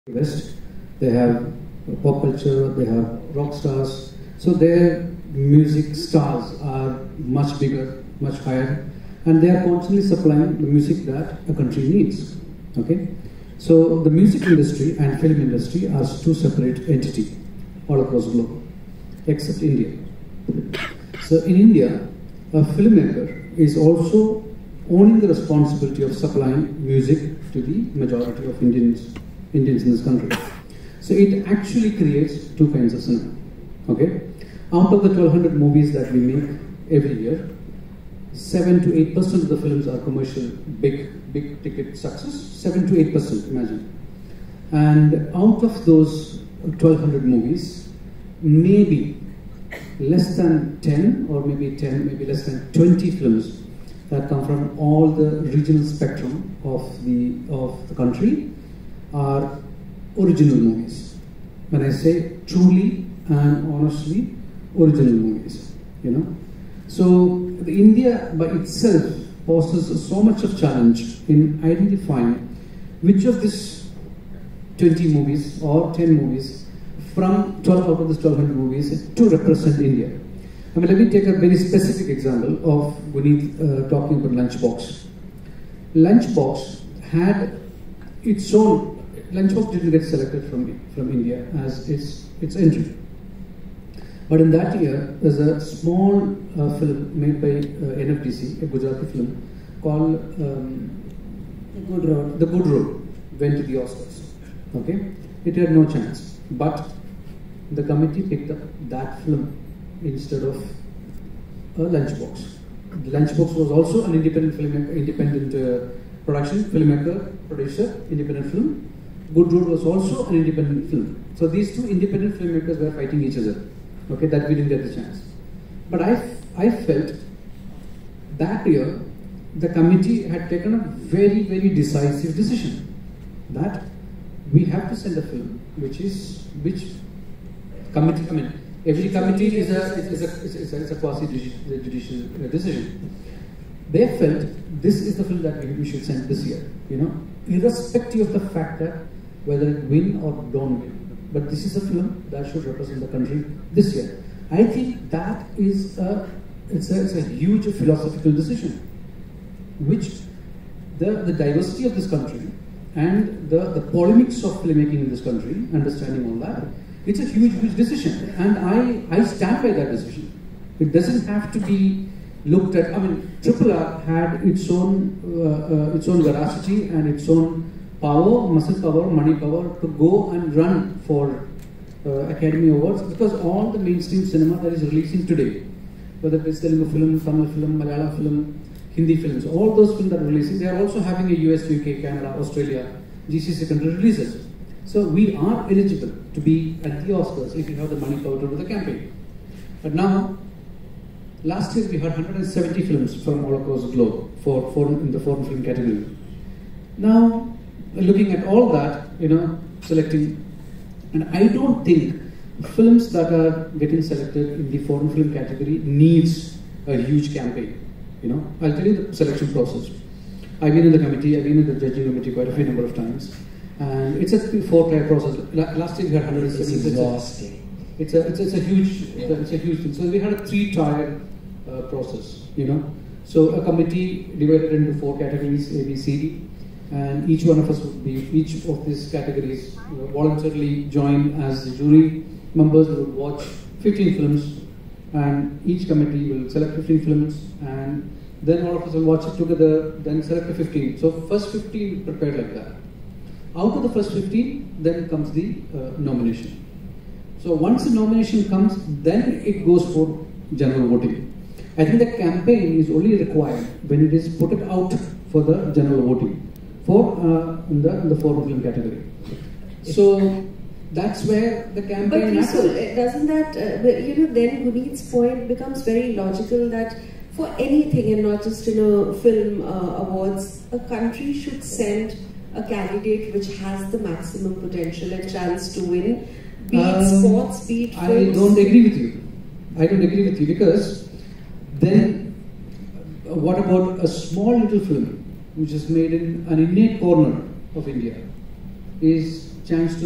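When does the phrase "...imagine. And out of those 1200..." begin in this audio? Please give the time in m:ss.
0:43.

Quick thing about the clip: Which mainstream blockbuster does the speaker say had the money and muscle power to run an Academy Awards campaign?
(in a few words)
Triple R.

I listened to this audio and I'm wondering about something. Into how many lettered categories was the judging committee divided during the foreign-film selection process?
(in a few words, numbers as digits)
four.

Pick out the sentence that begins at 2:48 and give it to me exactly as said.
And I, I stand by that decision.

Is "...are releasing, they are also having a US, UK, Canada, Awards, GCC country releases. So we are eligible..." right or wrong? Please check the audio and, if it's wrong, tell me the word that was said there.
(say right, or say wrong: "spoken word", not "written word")
wrong: "Australia", not "Awards".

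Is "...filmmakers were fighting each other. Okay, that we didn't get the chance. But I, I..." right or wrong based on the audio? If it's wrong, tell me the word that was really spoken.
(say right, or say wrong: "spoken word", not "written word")
right.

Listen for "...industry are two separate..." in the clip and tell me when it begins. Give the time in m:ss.
0:15.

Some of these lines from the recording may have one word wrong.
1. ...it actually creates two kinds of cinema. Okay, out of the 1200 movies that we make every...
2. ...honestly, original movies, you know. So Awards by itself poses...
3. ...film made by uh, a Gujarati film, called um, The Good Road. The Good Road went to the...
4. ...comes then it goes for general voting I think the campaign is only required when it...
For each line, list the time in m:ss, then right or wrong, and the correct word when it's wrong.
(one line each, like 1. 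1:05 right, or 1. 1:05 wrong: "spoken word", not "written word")
1. 0:31 right
2. 1:03 wrong: "India", not "Awards"
3. 1:36 right
4. 4:18 right.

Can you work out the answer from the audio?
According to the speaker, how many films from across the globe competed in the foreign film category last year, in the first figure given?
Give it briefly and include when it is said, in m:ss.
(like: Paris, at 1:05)
170, at 3:22.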